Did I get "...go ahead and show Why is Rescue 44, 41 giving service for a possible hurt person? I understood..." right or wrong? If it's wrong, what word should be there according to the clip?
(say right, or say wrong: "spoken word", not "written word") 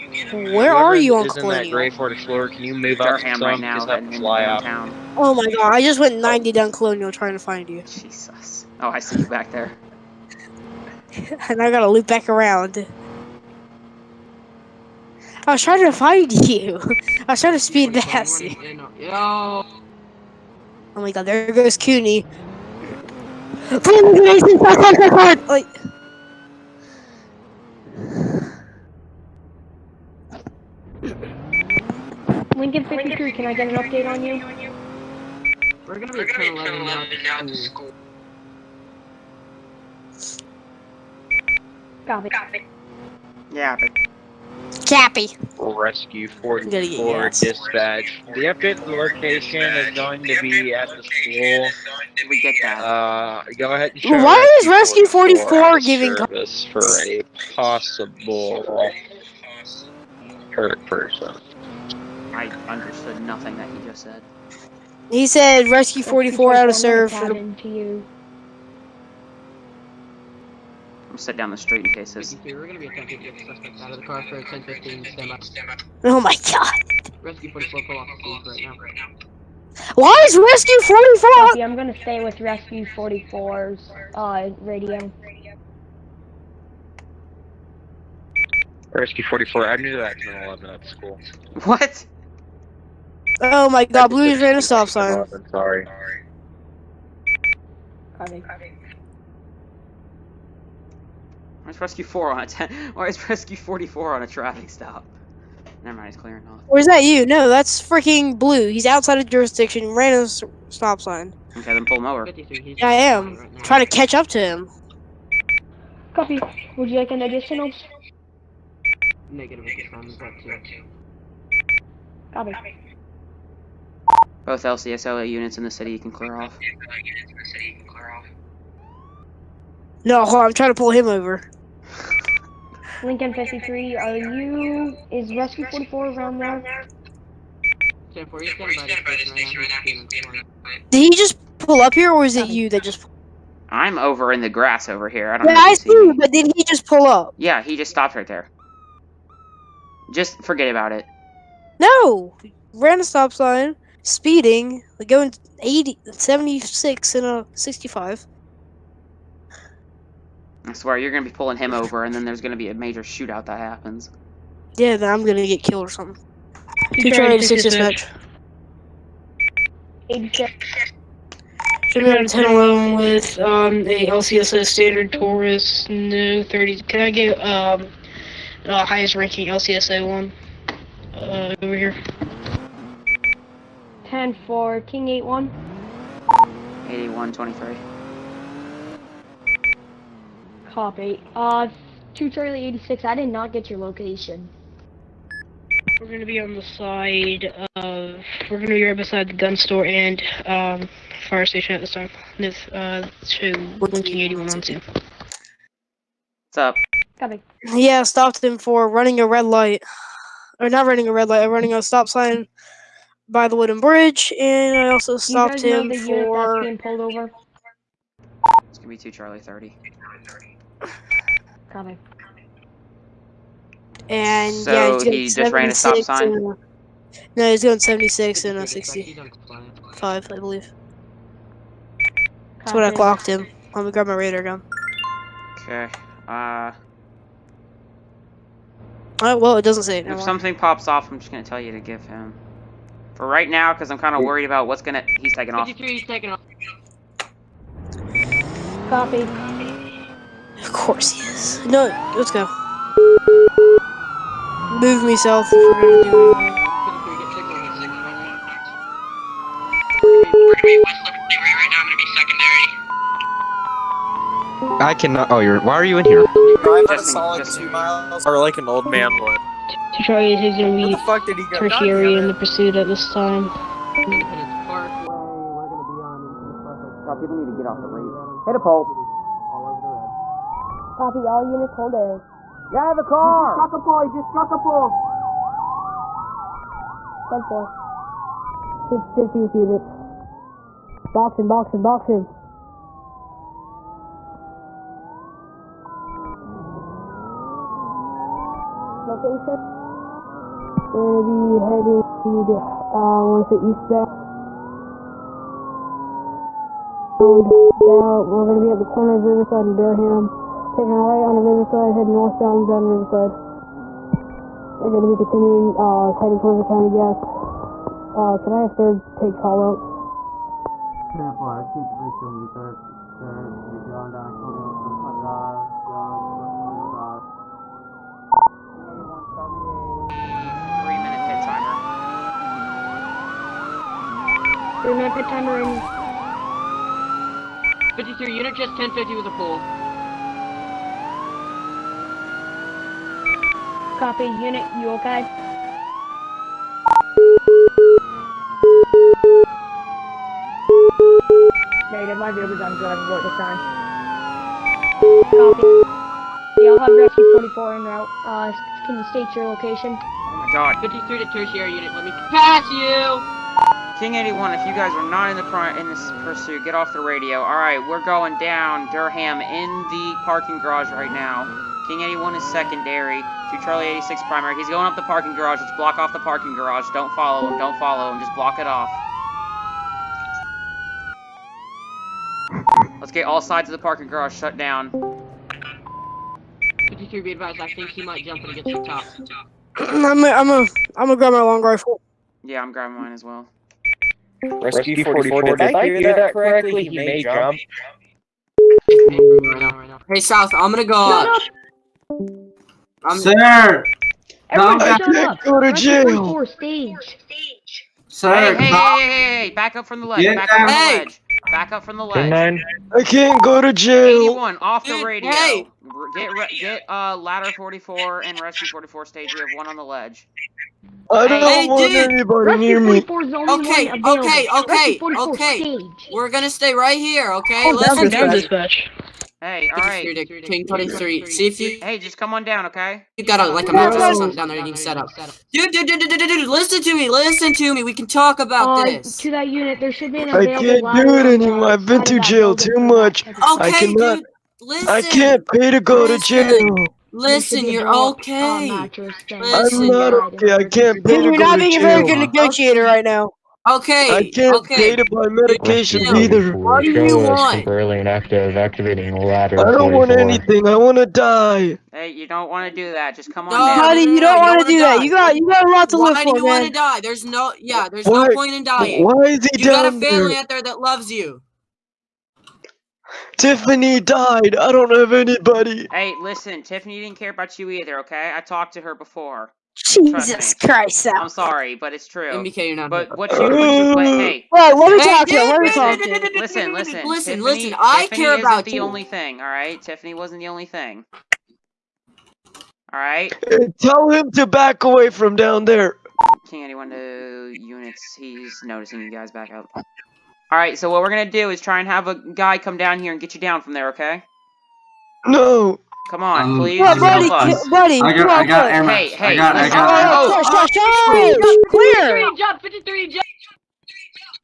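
wrong: "44", not "41".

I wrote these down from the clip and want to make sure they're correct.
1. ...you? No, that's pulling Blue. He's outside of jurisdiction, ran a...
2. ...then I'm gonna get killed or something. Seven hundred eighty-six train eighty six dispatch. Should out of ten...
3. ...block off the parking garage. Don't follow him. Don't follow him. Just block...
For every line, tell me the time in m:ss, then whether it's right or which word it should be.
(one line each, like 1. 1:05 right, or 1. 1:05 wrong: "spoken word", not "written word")
1. 1:47 wrong: "freaking", not "pulling"
2. 2:44 wrong: "Two", not "Seven"
3. 6:15 right.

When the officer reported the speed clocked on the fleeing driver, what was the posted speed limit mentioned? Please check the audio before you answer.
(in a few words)
65.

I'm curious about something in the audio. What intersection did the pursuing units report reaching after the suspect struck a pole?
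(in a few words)
Riverside and Durham.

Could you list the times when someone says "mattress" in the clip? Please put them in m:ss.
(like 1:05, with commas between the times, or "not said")
7:13.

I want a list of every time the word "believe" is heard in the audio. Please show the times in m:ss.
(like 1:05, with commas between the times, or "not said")
3:50.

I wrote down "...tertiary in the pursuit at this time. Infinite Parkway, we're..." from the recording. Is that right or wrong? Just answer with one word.
right.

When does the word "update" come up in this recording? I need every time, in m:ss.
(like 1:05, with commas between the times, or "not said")
0:33, 0:48.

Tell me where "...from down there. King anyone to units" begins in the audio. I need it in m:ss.
8:15.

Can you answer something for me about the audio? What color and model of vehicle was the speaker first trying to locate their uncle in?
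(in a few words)
Gray Ford Explorer.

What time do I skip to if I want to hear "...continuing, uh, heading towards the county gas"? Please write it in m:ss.
5:15.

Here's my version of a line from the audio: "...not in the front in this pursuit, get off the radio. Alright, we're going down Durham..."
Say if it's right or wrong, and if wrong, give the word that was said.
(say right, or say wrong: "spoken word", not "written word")
right.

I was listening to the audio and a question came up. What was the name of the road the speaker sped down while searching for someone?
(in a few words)
Colonial.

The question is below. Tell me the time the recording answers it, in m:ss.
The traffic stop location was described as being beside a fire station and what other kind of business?
3:19.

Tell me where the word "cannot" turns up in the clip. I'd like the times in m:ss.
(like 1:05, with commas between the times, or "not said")
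4:24, 7:23.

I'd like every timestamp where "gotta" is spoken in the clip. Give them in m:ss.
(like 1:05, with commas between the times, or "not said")
0:11.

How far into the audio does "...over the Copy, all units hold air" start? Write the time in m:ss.
4:39.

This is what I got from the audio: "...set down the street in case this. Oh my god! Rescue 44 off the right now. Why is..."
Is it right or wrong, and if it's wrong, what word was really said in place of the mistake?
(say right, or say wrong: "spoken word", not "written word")
right.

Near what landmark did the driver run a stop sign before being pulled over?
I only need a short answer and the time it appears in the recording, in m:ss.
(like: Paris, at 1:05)
Wooden bridge, at 3:33.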